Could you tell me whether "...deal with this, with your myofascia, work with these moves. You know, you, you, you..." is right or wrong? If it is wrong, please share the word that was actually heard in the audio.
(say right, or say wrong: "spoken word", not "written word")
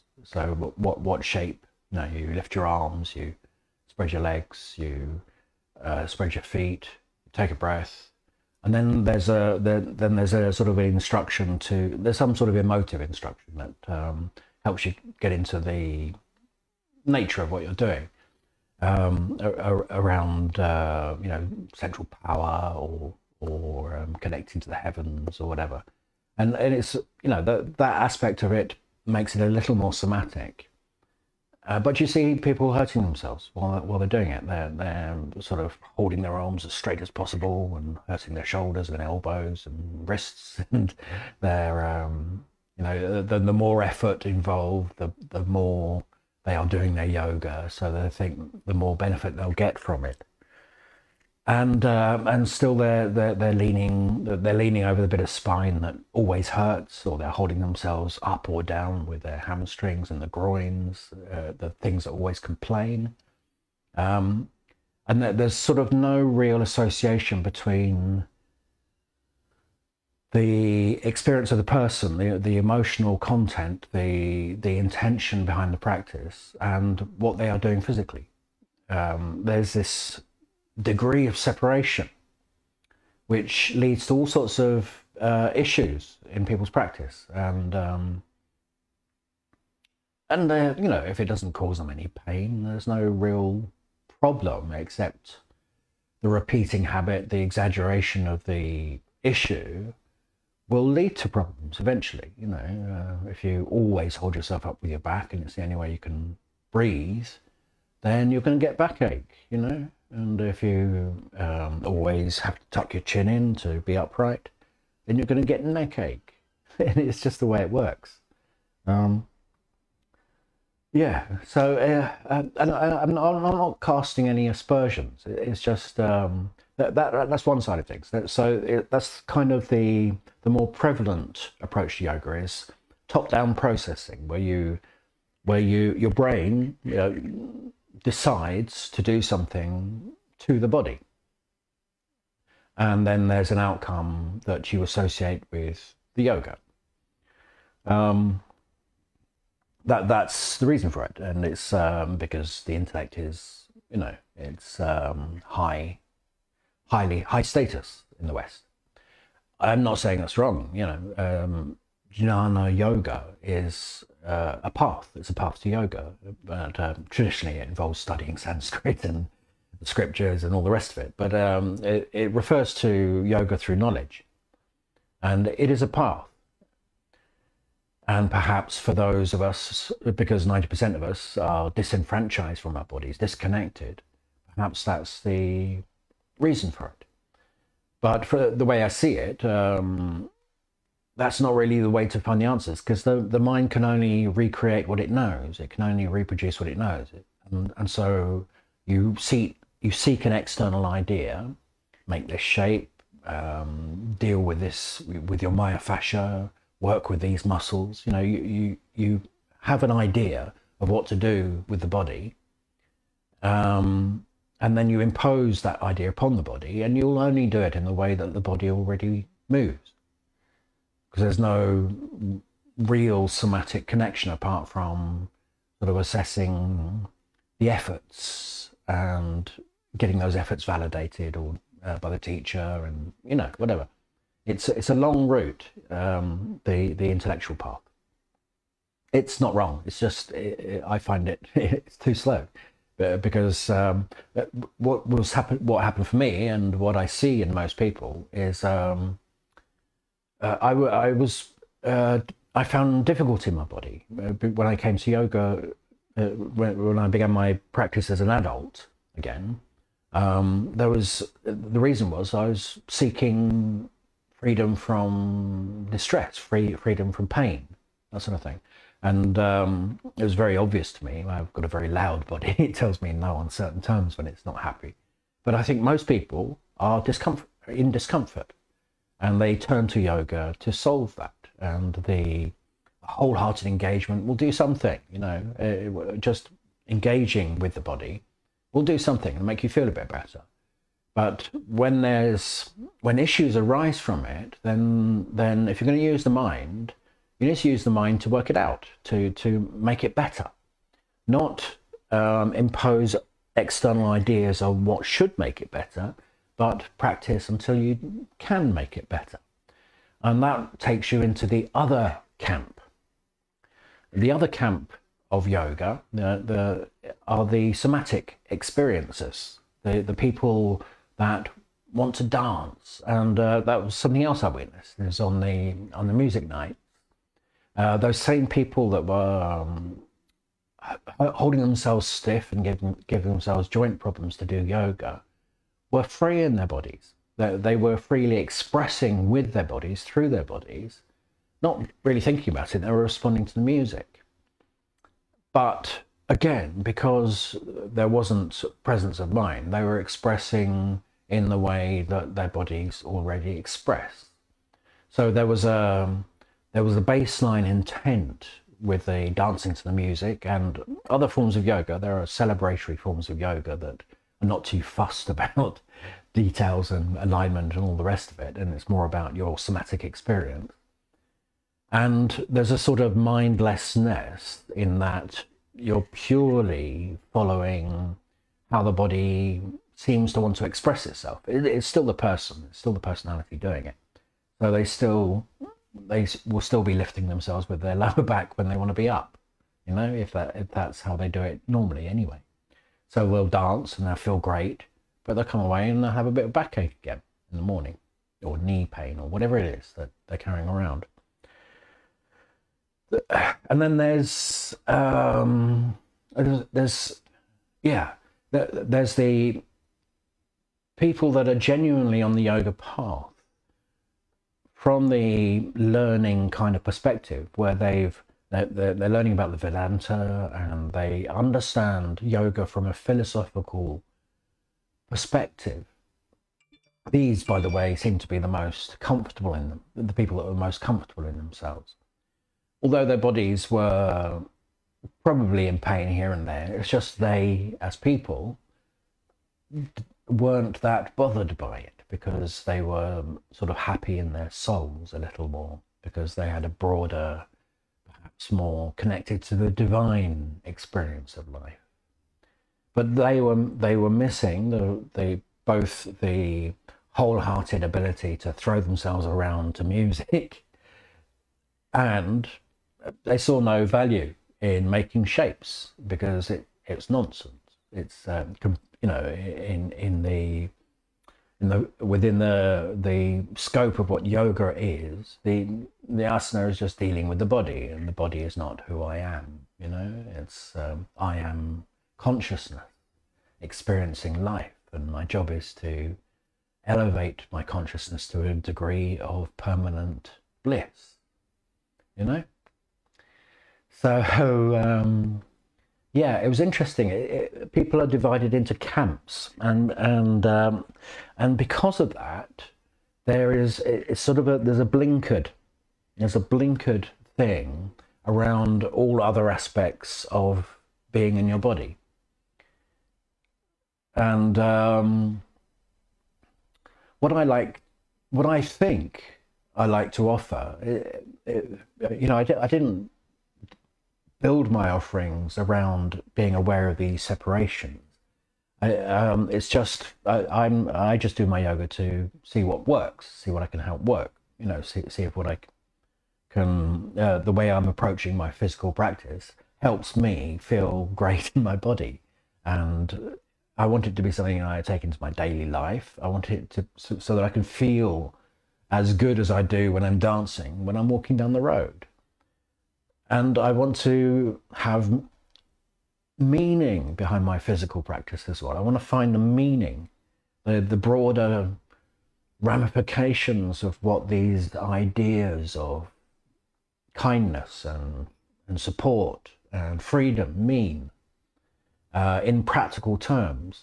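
wrong: "muscles", not "moves".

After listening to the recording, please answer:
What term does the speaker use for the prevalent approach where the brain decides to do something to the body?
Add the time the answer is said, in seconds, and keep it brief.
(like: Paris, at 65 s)
top down processing, at 133 s.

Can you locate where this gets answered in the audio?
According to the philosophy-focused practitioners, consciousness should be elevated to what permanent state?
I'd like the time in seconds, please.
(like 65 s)
489 s.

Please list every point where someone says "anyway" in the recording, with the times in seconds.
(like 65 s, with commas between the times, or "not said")
392 s.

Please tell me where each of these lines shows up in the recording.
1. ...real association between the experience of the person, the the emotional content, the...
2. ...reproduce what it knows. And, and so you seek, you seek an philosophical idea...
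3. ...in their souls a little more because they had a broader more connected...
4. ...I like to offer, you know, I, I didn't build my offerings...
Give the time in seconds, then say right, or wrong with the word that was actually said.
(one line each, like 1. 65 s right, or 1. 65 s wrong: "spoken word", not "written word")
1. 66 s right
2. 196 s wrong: "external", not "philosophical"
3. 444 s right
4. 519 s right.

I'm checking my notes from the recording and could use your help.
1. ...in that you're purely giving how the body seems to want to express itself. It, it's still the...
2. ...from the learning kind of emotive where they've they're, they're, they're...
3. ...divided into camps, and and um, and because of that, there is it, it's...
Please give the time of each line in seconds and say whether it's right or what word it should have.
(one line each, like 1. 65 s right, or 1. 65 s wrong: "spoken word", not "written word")
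1. 374 s wrong: "following", not "giving"
2. 414 s wrong: "perspective", not "emotive"
3. 498 s right.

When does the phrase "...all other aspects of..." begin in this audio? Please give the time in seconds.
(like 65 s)
508 s.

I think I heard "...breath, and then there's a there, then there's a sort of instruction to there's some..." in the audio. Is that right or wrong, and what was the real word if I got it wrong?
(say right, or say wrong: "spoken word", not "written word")
right.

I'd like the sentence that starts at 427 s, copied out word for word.
These, by the way, seem to be the most comfortable in them, the people that were most comfortable in themselves.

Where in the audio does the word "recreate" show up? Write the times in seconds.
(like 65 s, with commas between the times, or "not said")
194 s.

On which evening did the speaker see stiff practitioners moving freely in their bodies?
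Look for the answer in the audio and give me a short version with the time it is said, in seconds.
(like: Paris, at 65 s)
music night, at 326 s.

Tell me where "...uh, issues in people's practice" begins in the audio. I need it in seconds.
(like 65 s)
85 s.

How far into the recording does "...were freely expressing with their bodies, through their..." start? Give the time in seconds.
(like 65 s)
337 s.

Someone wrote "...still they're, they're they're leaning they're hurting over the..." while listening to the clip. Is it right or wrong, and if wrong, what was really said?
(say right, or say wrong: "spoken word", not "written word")
wrong: "leaning", not "hurting".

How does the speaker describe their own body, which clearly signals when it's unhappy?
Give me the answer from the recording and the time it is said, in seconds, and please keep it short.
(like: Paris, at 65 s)
a very loud body, at 271 s.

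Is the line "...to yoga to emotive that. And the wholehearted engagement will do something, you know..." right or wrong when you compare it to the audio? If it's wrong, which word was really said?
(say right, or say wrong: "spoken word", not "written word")
wrong: "solve", not "emotive".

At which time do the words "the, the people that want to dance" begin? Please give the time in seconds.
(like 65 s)
319 s.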